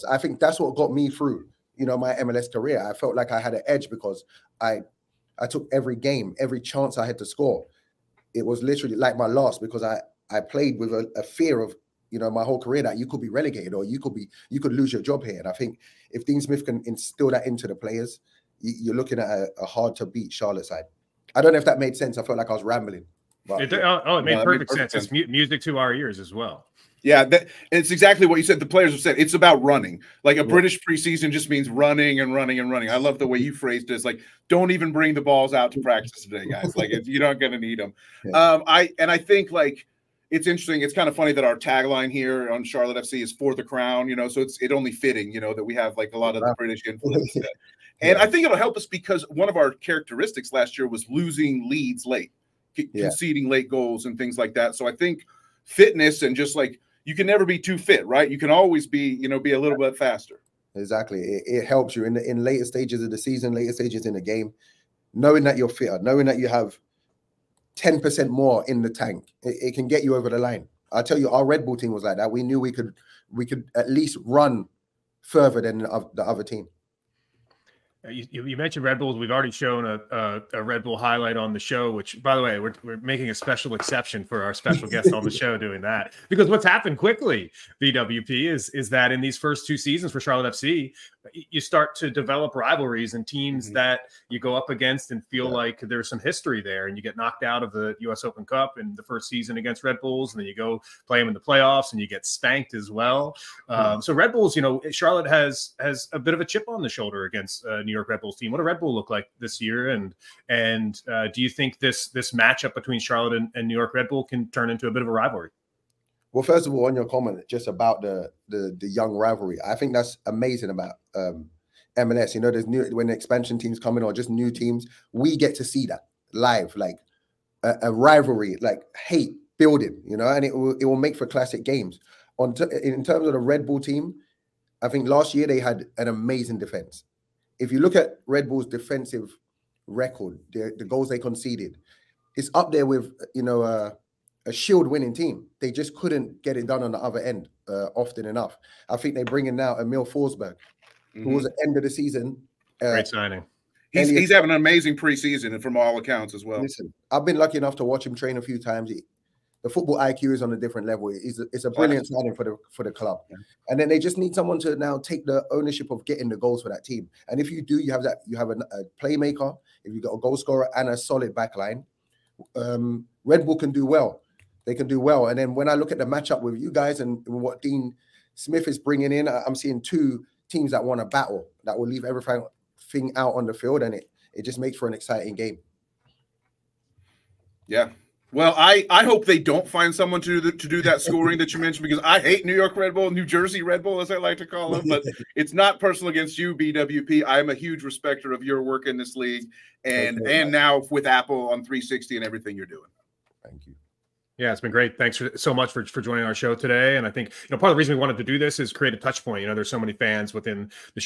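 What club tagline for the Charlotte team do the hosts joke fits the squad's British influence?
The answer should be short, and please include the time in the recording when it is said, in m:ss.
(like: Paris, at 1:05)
For the crown, at 0:43.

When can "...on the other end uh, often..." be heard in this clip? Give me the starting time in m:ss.
2:26.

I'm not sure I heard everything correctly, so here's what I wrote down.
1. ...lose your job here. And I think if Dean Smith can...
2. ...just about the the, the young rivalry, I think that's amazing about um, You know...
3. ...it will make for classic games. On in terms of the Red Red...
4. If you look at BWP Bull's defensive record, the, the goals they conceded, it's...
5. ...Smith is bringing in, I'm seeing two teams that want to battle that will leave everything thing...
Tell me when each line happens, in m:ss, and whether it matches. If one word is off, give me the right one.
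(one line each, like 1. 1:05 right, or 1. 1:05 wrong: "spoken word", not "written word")
1. 0:14 right
2. 1:57 right
3. 2:10 wrong: "Bull", not "Red"
4. 2:17 wrong: "Red", not "BWP"
5. 2:58 right.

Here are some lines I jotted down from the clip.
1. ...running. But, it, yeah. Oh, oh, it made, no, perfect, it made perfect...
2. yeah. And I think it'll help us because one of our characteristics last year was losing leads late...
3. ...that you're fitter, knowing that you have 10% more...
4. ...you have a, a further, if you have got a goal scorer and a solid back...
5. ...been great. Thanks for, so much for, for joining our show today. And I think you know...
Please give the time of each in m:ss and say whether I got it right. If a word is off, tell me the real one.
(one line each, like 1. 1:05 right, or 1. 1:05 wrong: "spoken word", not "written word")
1. 0:22 wrong: "rambling", not "running"
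2. 0:47 right
3. 1:05 right
4. 2:48 wrong: "playmaker", not "further"
5. 3:24 right.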